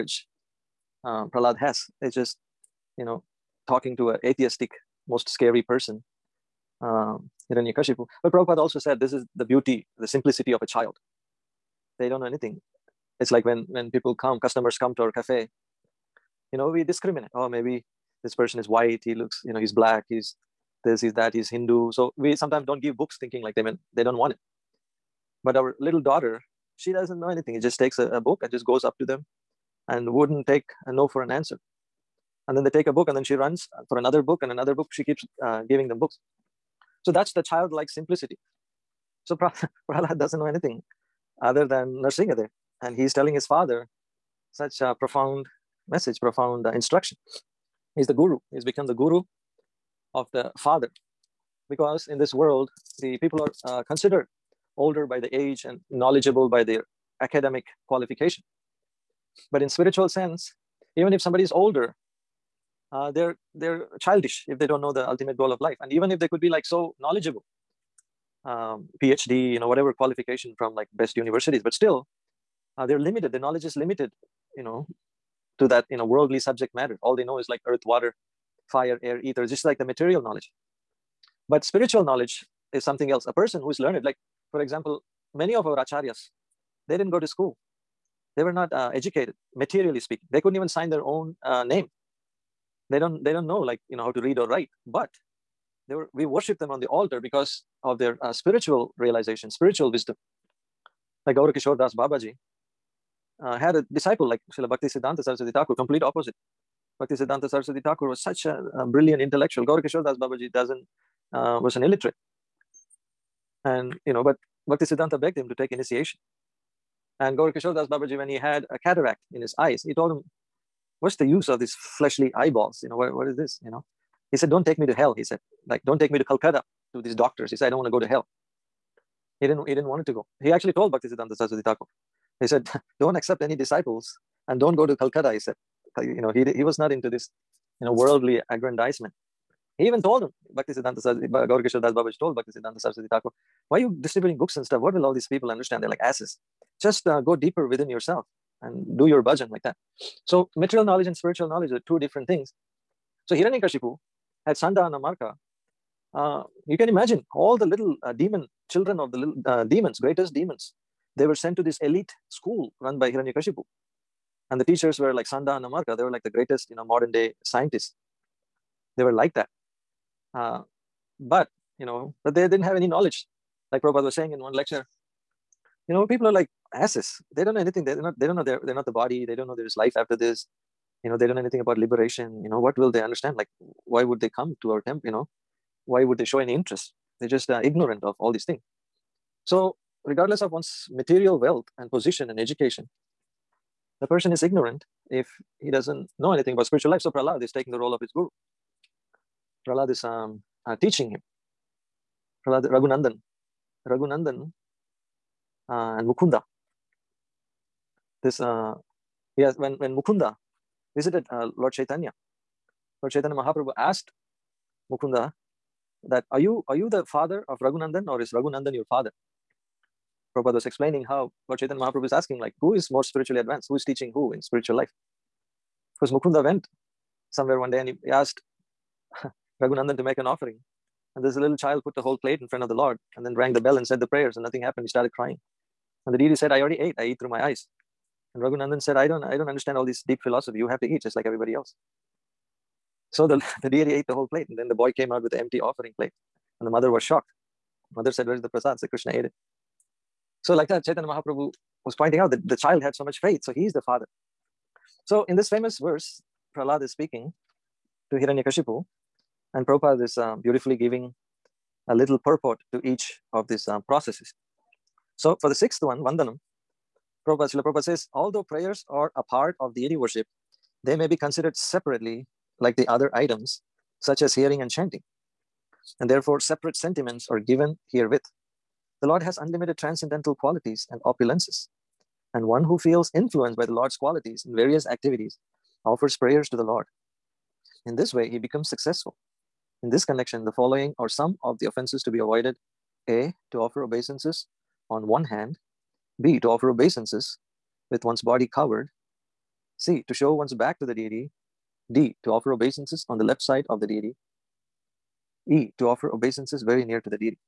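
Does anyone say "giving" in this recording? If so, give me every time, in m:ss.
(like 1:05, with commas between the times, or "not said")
0:35, 4:20.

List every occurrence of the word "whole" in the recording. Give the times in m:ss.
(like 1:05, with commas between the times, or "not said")
3:52, 4:04.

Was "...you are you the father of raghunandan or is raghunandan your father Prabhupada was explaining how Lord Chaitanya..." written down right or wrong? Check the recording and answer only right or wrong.
right.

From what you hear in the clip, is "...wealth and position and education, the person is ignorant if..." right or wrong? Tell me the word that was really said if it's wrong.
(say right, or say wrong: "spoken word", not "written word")
right.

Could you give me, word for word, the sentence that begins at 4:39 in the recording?
The Lord has unlimited transcendental qualities and opulences.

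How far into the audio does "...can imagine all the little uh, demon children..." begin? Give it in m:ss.
2:36.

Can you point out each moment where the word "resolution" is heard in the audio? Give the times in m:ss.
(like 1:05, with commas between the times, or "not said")
not said.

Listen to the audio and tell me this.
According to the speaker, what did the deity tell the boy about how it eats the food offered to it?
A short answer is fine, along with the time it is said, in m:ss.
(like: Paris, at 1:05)
I eat through my eyes, at 3:56.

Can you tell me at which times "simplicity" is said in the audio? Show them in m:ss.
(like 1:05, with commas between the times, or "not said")
0:10, 0:37.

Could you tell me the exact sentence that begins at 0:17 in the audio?
Oh, maybe this person is white, he looks, you know, he's black, he's this, he's that, he's Hindu.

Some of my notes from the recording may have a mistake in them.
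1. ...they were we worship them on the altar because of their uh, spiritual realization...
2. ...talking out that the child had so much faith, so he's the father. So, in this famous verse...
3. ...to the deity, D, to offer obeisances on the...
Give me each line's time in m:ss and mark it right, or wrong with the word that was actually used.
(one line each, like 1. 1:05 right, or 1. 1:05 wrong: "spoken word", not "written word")
1. 1:35 right
2. 4:11 wrong: "pointing", not "talking"
3. 5:00 right.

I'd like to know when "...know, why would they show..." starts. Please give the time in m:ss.
3:05.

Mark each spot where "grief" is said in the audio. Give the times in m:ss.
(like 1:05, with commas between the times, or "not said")
not said.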